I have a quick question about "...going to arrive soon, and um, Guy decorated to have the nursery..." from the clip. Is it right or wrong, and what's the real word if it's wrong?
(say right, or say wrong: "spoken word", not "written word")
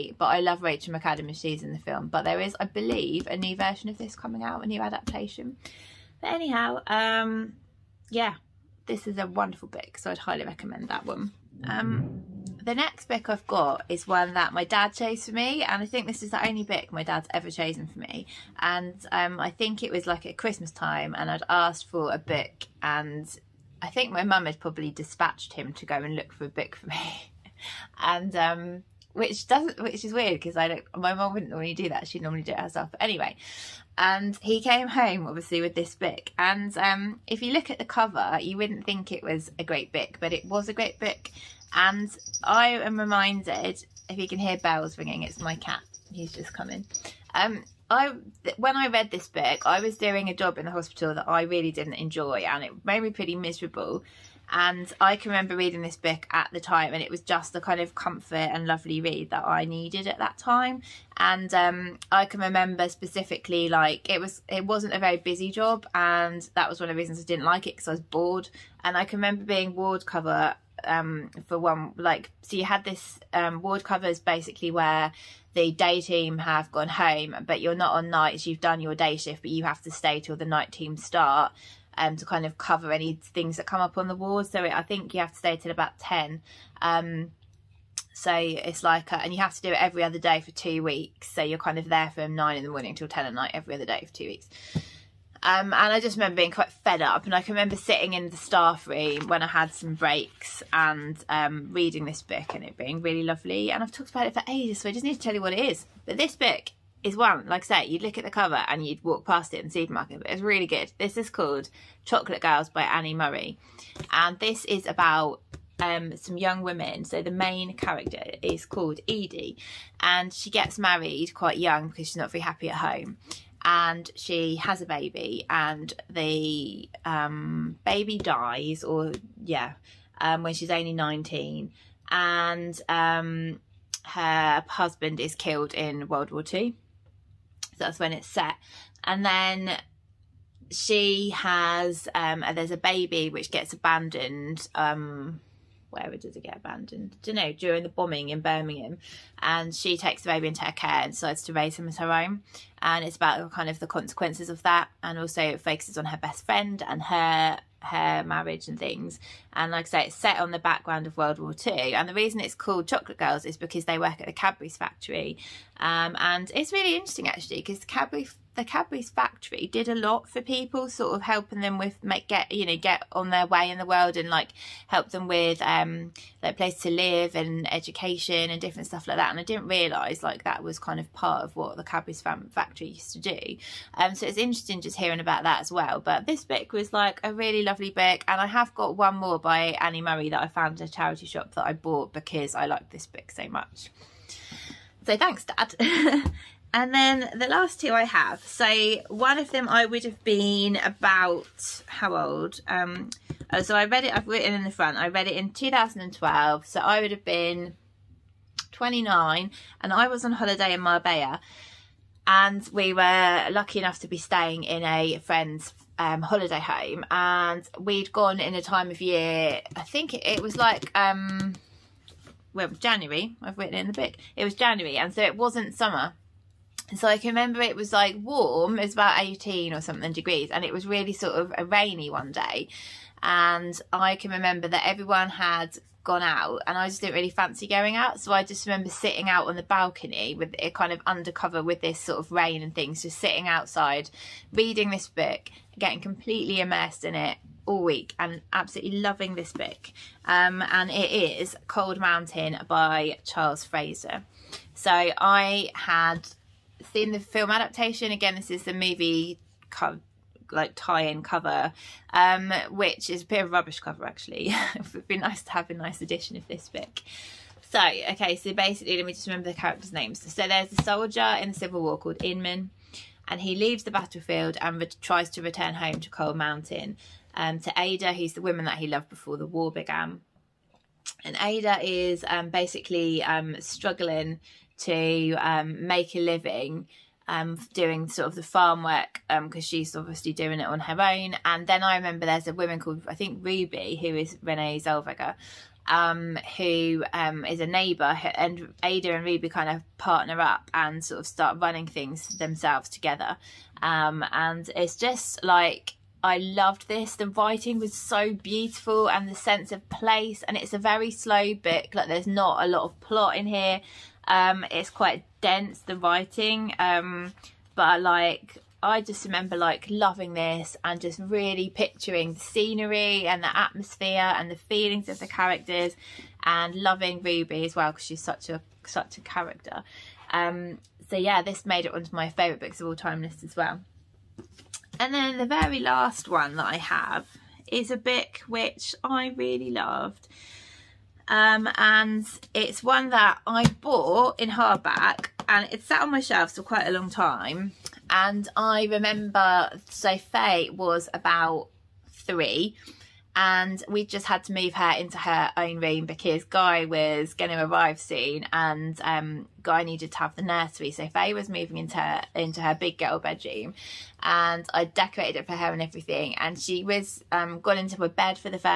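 wrong: "needed", not "decorated".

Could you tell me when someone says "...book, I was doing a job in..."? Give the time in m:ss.
0:49.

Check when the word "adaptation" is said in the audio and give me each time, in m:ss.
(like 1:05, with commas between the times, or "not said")
0:04, 4:17.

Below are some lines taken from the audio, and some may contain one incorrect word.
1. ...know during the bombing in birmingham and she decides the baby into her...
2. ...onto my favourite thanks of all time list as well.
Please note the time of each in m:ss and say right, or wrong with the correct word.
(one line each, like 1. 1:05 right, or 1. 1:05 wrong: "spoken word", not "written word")
1. 2:27 wrong: "takes", not "decides"
2. 5:31 wrong: "books", not "thanks".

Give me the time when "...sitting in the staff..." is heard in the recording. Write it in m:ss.
1:37.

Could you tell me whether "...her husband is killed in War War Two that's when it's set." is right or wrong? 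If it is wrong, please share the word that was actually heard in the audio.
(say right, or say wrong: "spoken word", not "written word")
wrong: "World", not "War".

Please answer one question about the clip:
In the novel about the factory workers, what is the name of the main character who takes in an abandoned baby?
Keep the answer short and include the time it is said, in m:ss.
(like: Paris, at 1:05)
Edie, at 1:59.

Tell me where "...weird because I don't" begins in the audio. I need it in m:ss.
0:30.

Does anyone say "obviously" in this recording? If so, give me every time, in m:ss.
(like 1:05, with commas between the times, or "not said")
0:35, 4:49.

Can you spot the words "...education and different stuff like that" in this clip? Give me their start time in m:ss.
2:57.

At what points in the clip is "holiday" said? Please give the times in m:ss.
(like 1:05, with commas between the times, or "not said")
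3:30, 3:36.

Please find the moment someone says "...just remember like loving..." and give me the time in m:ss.
5:19.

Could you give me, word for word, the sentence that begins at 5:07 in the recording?
The writing was so beautiful and the sense of place and it's a very slow book.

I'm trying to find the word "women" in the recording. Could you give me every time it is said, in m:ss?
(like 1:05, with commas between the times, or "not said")
1:56.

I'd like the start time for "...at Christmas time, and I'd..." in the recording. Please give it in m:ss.
0:20.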